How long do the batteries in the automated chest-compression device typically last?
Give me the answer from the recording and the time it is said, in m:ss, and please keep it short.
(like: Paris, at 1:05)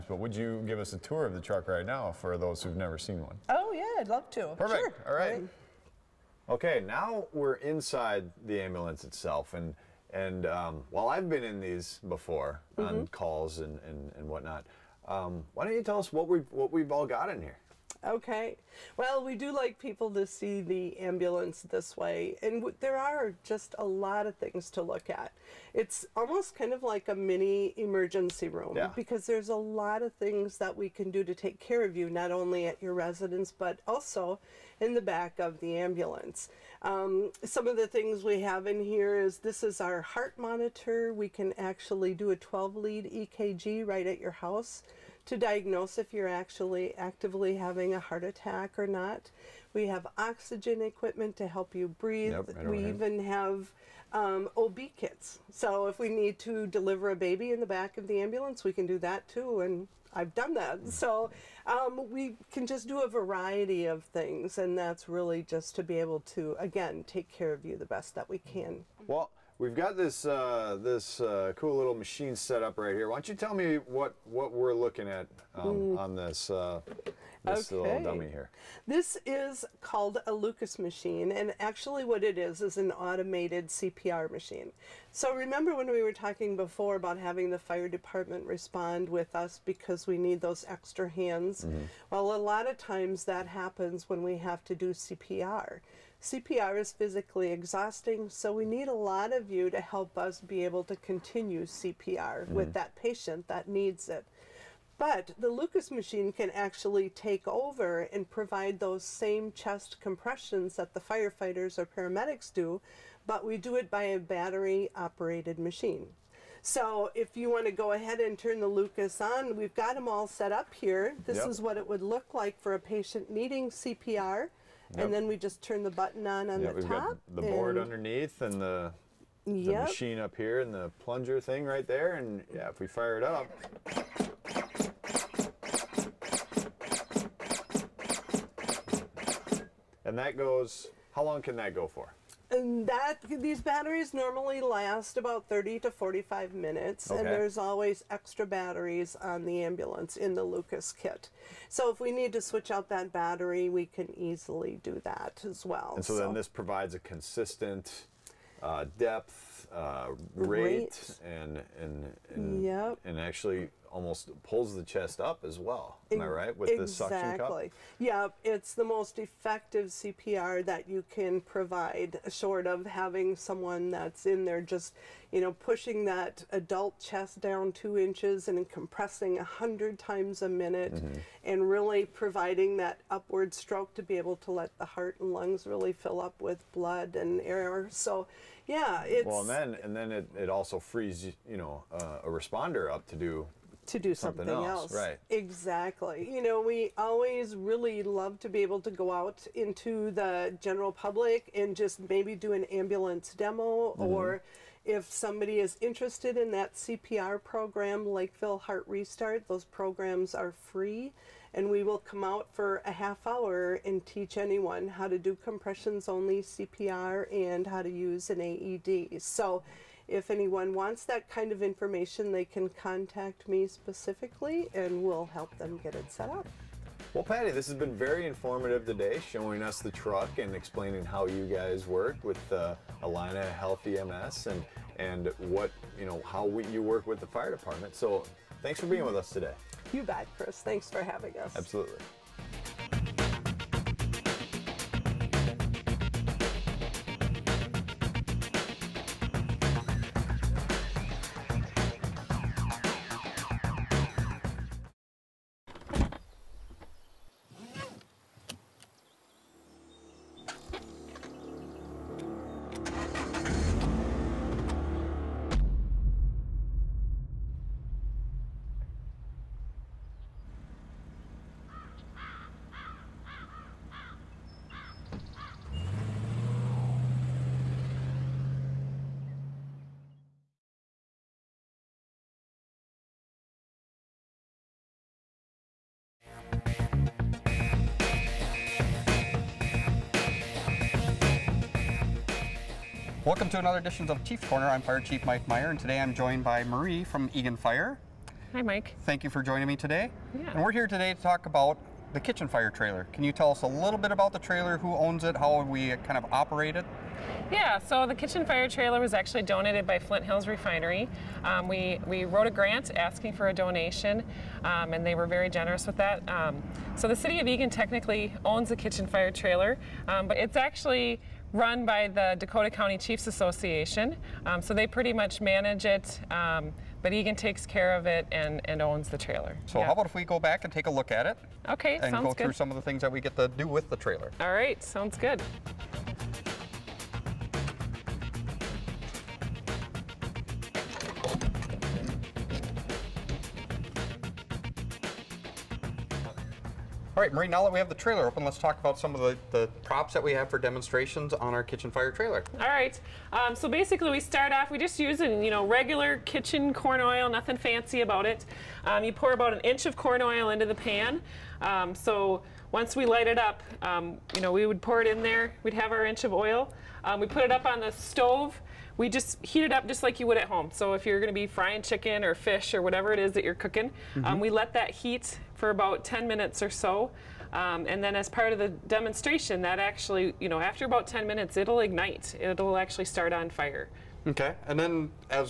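30 to 45 minutes, at 2:25.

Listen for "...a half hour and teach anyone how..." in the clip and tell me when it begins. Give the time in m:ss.
3:32.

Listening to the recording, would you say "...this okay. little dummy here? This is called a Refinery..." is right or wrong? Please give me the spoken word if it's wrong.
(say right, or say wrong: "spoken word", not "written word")
wrong: "Lucas", not "Refinery".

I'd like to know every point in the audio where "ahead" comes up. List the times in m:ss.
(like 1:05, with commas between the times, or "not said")
0:52, 1:57.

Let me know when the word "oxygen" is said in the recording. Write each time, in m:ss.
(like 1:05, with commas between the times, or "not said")
0:50.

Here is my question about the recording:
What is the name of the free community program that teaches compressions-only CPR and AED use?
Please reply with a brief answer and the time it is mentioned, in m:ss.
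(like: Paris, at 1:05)
Lakeville Heart Restart, at 3:28.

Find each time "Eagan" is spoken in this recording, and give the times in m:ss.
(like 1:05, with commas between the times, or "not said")
4:57, 5:17, 5:27.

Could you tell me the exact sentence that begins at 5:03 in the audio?
Can you tell us a little bit about the trailer, who owns it, how we kind of operate it?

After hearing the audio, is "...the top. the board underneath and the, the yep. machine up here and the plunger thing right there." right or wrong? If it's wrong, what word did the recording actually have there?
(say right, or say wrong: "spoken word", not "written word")
right.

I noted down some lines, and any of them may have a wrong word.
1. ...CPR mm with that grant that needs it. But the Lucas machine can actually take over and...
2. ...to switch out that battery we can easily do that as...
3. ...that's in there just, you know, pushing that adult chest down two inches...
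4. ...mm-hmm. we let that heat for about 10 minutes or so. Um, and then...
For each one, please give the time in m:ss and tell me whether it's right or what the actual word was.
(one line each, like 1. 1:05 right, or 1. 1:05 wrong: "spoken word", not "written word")
1. 1:41 wrong: "patient", not "grant"
2. 2:32 right
3. 2:53 right
4. 6:14 right.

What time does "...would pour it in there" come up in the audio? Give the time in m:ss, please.
6:04.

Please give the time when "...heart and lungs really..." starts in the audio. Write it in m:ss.
3:04.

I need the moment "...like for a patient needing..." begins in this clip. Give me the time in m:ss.
2:02.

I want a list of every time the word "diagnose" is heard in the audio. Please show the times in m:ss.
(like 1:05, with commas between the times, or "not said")
0:45.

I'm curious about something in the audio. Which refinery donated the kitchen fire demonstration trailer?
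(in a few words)
Flint Hills Refinery.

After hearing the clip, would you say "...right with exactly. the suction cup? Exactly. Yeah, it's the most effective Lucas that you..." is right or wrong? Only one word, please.
wrong.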